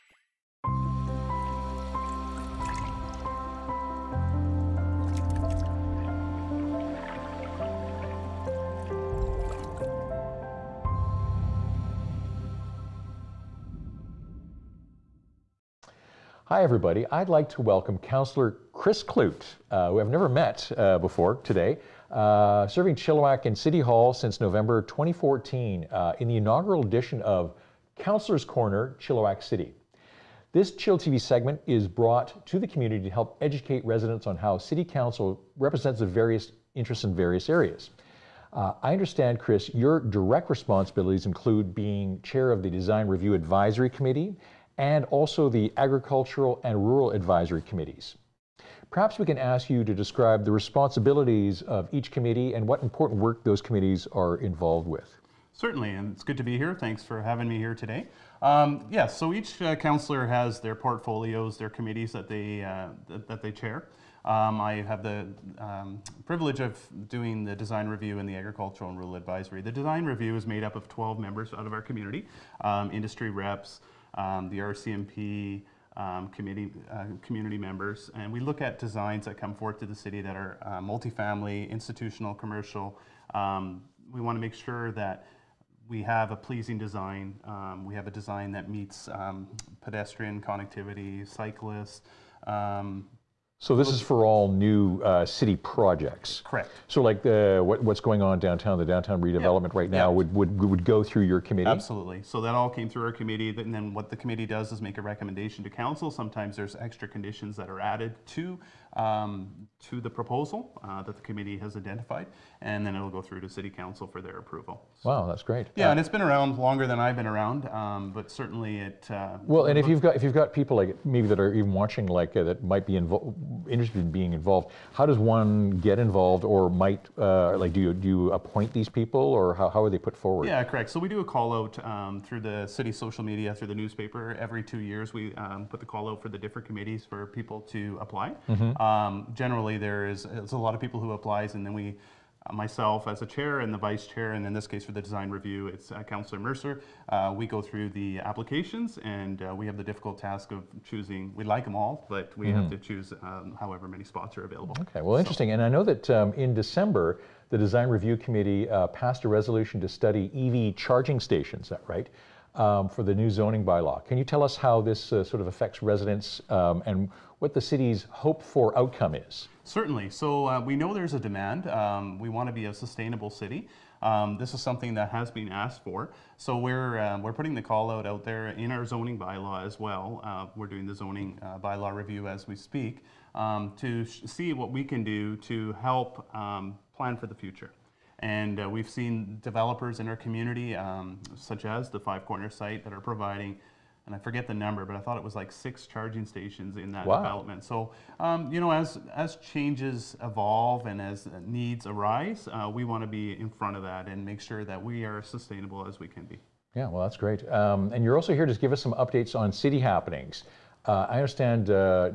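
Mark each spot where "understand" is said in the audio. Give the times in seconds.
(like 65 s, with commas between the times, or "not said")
38 s, 211 s.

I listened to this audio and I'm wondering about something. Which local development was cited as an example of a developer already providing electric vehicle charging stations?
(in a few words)
Five Corner site.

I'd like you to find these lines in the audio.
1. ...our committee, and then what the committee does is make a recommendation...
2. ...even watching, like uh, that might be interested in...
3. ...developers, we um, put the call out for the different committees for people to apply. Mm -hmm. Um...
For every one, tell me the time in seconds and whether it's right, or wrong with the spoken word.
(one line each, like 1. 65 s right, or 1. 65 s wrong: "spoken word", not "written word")
1. 103 s right
2. 121 s right
3. 134 s wrong: "years", not "developers".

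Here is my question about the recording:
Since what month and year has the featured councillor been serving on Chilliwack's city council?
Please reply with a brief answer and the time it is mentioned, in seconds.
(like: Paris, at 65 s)
November 2014, at 24 s.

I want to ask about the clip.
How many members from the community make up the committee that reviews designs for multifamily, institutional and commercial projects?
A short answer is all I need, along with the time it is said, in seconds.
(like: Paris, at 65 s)
12, at 70 s.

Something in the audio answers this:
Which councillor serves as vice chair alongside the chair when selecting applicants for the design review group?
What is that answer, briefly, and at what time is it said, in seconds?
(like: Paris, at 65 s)
Councillor Mercer, at 146 s.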